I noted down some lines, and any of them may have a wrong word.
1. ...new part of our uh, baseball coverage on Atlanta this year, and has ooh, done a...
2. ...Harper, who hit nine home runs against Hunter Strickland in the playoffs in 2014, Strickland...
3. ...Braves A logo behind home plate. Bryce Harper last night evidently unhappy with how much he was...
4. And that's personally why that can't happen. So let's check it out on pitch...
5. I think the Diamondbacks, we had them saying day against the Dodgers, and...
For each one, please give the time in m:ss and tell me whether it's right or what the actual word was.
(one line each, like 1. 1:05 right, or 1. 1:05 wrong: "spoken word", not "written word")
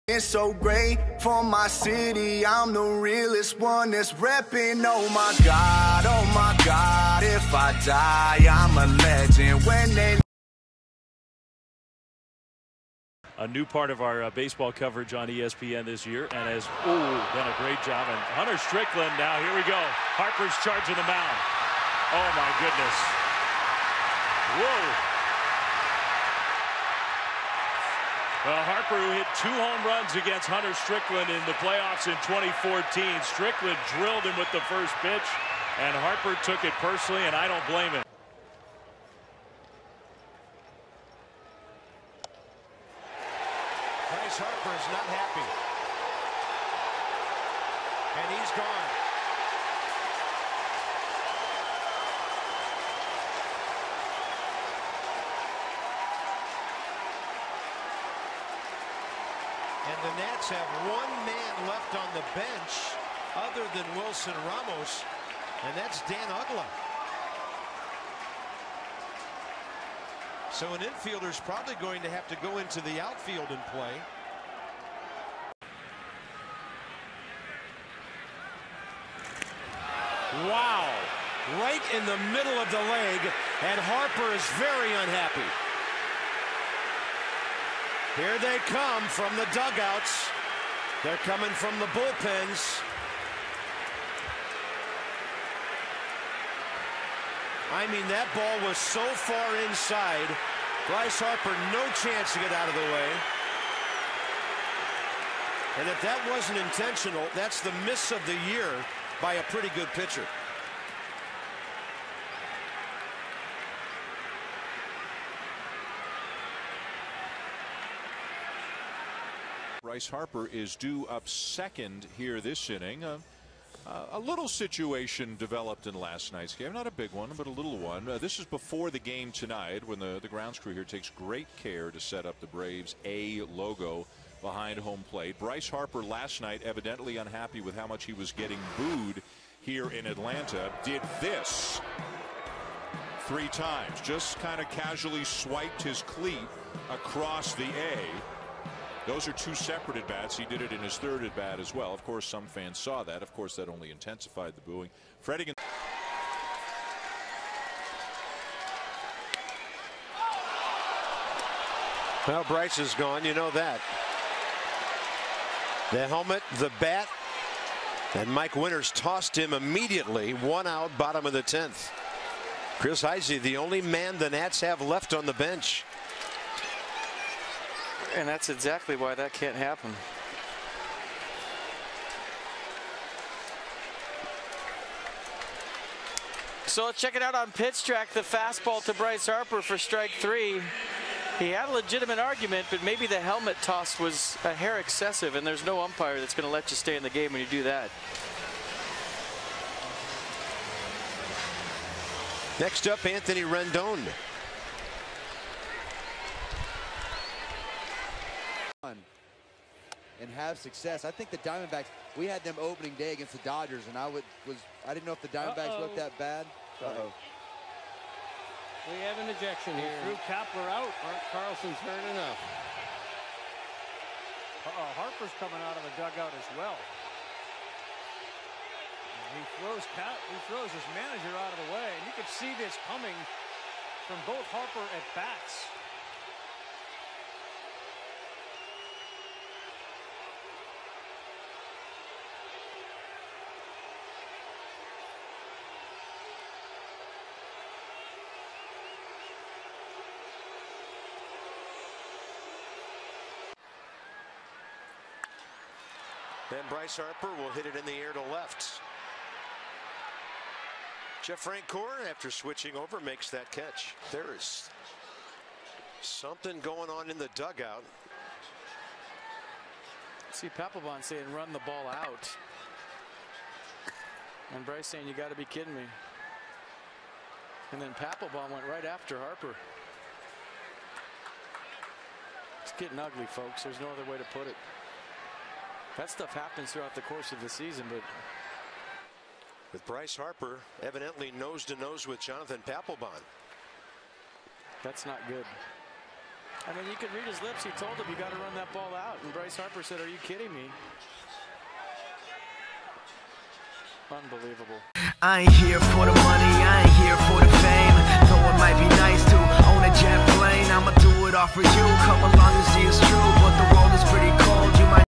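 1. 0:13 wrong: "ESPN", not "Atlanta"
2. 0:28 wrong: "two", not "nine"
3. 2:12 right
4. 2:58 wrong: "exactly", not "personally"
5. 3:31 wrong: "opening", not "saying".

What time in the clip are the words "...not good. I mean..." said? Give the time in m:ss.
4:55.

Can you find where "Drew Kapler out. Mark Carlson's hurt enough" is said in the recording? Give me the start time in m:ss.
3:40.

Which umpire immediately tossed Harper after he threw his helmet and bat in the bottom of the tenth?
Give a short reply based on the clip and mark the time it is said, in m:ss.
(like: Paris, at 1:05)
Mike Winters, at 2:48.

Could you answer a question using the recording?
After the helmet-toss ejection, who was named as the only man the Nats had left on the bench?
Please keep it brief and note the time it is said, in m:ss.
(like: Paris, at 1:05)
Chris Heisey, at 2:52.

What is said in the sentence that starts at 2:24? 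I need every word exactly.
Just kind of casually swiped his cleat across the A those are two separate at bats.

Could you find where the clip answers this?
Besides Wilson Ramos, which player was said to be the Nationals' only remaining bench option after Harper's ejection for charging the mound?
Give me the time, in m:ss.
1:06.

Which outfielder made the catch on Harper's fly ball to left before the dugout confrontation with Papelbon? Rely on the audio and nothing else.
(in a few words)
Jeff Francoeur.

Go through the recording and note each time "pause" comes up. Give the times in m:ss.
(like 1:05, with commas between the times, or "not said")
not said.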